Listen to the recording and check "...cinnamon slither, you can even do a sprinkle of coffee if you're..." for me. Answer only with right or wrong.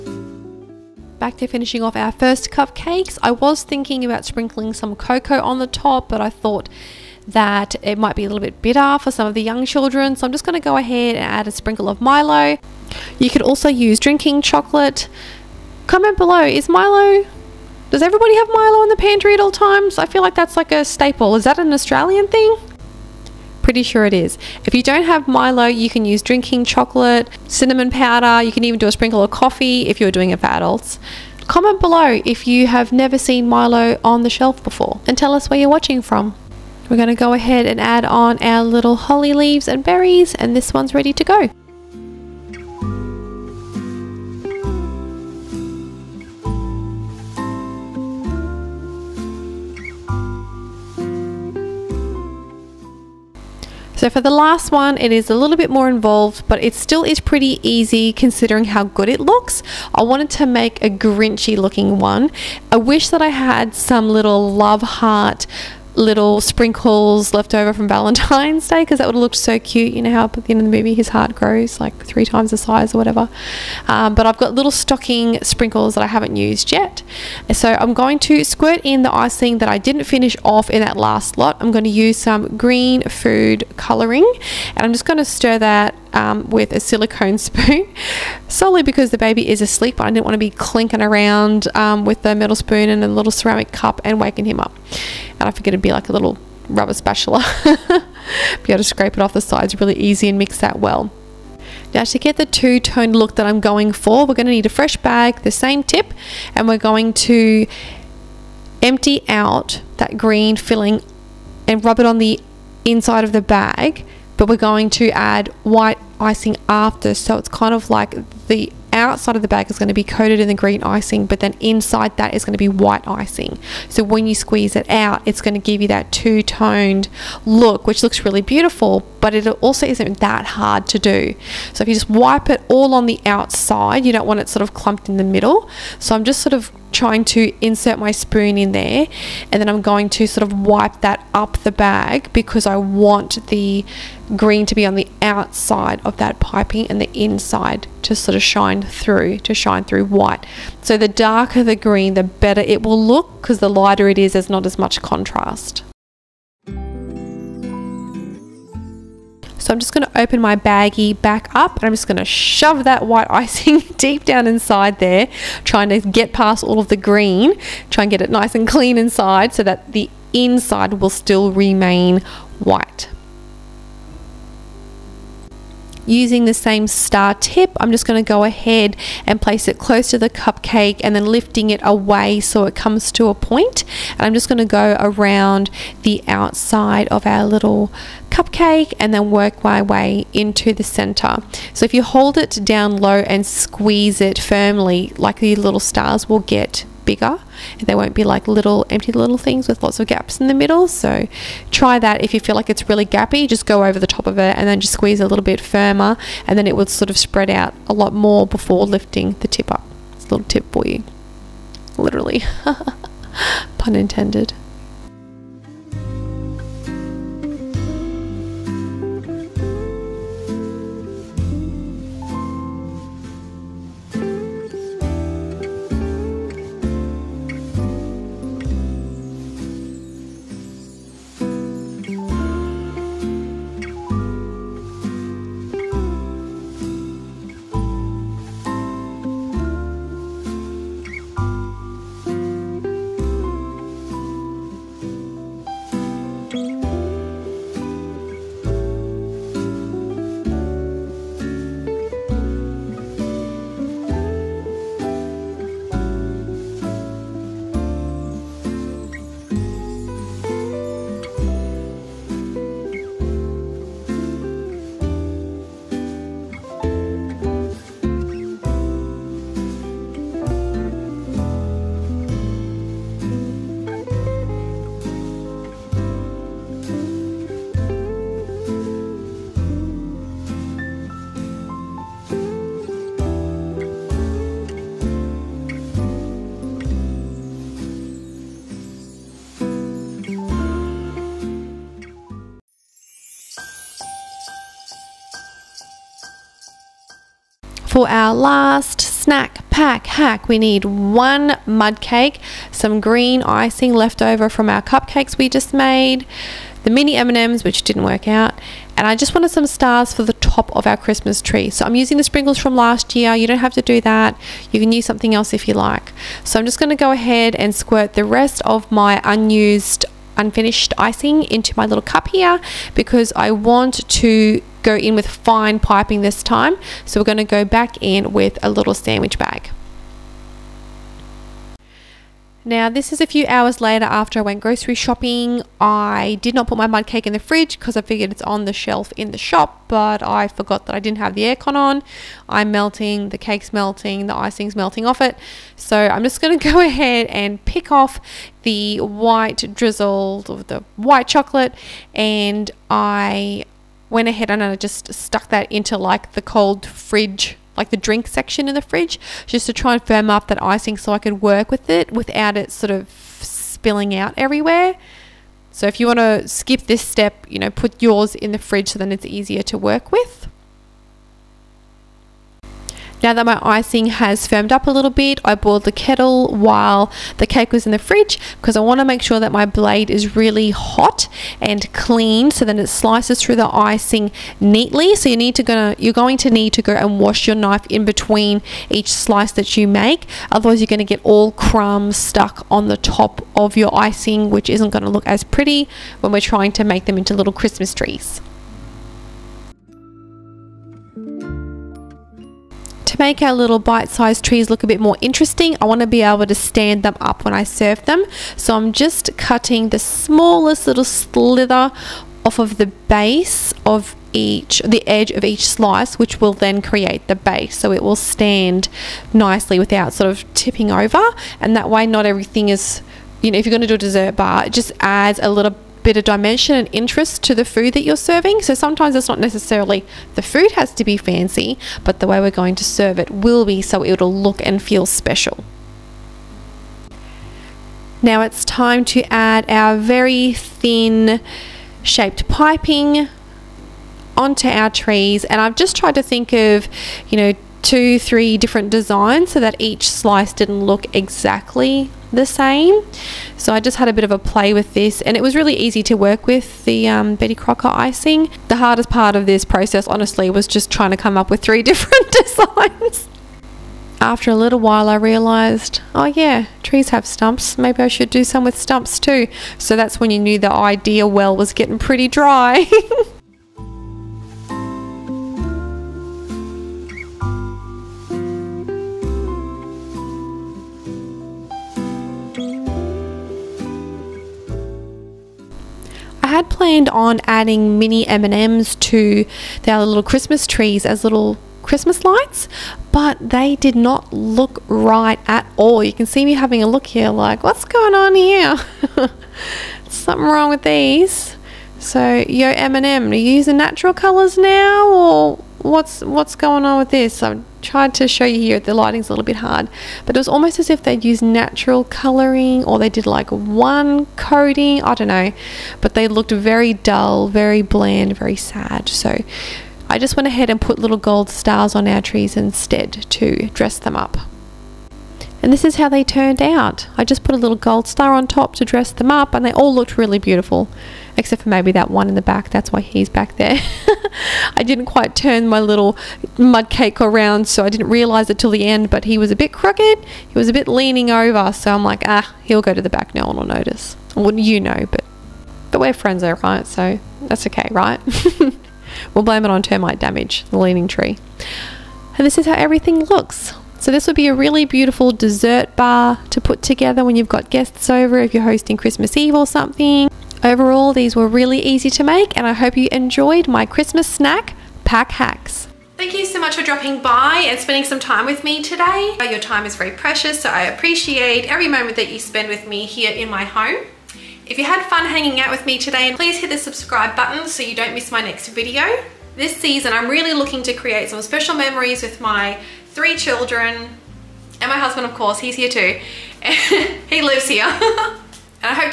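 wrong.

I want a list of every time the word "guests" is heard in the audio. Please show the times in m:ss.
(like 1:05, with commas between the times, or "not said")
9:17.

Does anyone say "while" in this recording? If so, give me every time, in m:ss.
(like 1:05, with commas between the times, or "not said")
6:16, 7:44.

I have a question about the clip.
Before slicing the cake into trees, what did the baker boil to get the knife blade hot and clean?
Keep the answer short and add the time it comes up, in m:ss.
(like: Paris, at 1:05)
the kettle, at 6:15.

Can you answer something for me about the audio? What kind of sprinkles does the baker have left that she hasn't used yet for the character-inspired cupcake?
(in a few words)
stocking sprinkles.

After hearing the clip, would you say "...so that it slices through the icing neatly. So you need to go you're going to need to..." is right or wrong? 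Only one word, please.
right.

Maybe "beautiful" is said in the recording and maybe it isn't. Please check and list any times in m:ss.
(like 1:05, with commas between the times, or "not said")
2:08, 8:50, 9:14.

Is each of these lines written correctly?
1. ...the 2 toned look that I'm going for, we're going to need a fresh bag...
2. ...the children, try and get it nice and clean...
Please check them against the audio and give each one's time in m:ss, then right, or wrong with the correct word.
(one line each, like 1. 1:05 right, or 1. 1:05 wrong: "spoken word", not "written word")
1. 1:42 right
2. 2:46 wrong: "green", not "children".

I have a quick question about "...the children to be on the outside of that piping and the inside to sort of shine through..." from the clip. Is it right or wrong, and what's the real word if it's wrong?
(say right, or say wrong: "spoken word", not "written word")
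wrong: "green", not "children".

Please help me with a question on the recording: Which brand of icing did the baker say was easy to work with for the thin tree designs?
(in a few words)
Betty Crocker.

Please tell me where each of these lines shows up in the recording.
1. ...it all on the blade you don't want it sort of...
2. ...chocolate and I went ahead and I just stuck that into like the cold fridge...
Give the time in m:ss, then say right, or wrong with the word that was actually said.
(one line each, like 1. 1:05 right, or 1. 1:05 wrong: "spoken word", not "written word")
1. 2:12 wrong: "outside", not "blade"
2. 5:51 right.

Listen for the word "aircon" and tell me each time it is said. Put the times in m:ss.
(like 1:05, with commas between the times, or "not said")
5:41.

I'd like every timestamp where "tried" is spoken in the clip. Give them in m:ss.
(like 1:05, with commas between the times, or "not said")
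7:25, 8:27.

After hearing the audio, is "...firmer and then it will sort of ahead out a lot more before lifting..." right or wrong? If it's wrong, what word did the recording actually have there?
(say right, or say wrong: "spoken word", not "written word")
wrong: "spread", not "ahead".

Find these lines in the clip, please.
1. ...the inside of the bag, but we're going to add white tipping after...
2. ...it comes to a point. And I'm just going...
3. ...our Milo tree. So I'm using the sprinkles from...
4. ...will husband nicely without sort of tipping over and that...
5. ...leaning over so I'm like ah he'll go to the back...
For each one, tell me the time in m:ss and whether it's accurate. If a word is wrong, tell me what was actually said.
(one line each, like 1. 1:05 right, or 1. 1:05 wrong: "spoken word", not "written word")
1. 1:52 wrong: "icing", not "tipping"
2. 3:02 right
3. 5:10 wrong: "Christmas", not "Milo"
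4. 6:58 wrong: "stand", not "husband"
5. 9:00 right.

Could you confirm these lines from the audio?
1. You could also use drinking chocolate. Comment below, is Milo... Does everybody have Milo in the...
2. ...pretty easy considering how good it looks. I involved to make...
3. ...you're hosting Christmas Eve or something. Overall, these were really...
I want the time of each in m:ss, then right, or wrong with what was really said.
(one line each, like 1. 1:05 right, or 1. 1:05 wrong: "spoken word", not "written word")
1. 0:13 right
2. 0:57 wrong: "wanted", not "involved"
3. 9:18 right.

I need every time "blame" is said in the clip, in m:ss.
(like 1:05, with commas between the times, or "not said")
9:09.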